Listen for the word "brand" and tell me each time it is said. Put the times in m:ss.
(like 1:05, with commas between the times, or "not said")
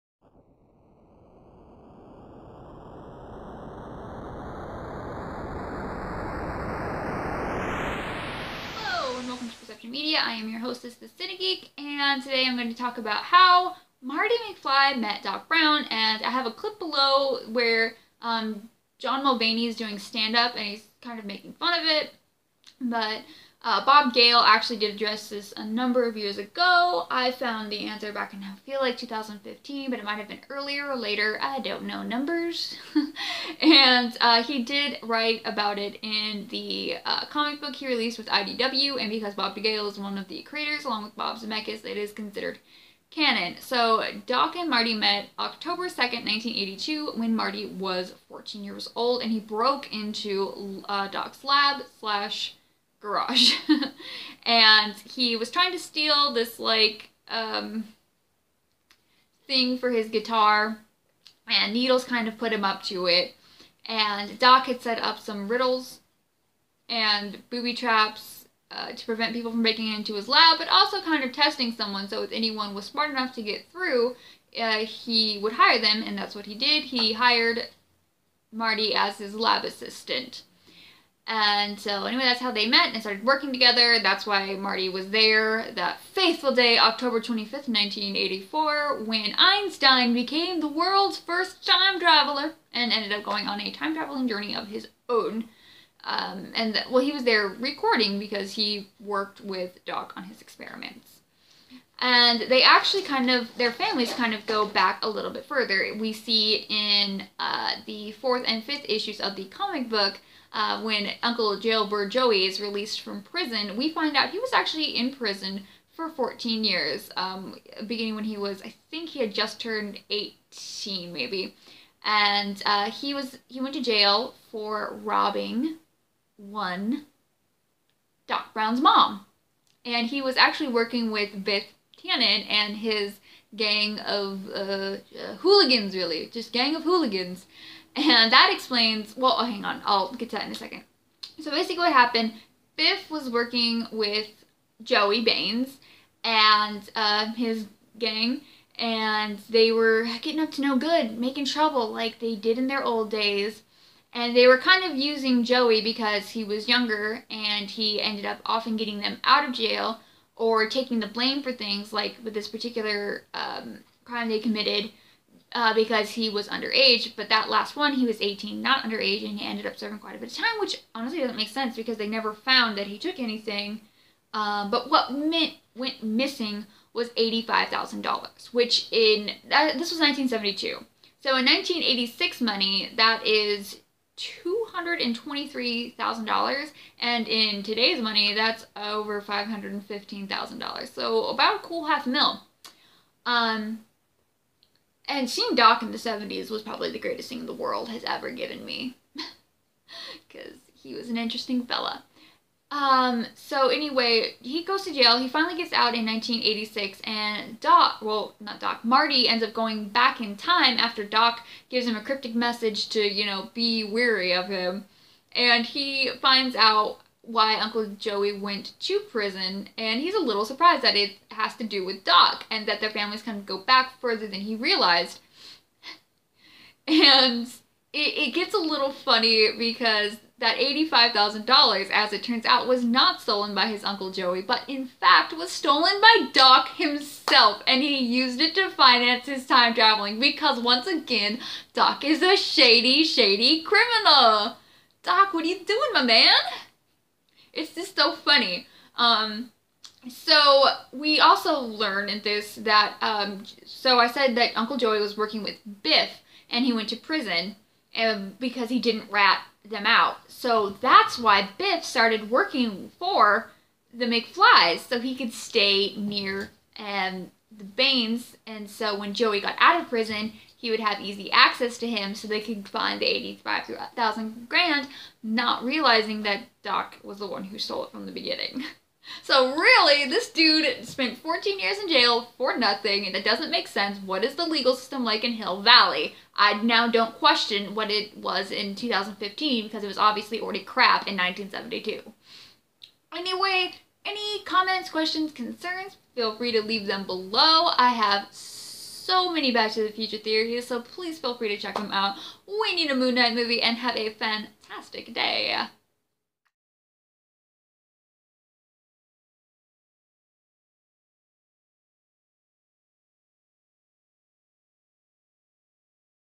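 not said.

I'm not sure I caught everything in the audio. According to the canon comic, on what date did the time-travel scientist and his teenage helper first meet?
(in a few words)
October 2nd, 1982.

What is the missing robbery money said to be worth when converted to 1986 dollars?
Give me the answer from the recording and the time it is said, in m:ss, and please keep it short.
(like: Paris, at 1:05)
$223,000, at 3:04.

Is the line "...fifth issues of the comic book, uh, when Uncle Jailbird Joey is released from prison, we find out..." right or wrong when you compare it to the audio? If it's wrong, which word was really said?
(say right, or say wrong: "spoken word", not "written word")
right.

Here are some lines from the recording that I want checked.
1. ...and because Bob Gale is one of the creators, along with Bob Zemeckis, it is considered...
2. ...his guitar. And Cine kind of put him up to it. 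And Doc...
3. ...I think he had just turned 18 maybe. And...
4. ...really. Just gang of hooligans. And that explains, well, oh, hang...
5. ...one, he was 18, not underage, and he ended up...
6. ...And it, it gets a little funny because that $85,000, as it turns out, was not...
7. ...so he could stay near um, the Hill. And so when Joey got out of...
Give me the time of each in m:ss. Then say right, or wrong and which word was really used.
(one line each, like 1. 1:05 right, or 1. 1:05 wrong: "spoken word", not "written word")
1. 0:38 right
2. 0:59 wrong: "Needles", not "Cine"
3. 1:58 right
4. 2:15 right
5. 2:47 right
6. 3:46 right
7. 4:24 wrong: "Baines", not "Hill".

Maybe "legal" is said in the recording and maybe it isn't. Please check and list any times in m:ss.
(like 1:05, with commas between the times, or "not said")
4:44.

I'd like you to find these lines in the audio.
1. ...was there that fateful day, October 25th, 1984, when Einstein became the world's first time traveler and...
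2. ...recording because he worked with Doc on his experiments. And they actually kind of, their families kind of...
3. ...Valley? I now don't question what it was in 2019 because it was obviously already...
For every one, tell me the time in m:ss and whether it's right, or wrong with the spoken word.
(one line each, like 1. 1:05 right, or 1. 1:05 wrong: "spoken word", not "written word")
1. 1:24 right
2. 1:37 right
3. 4:45 wrong: "2015", not "2019".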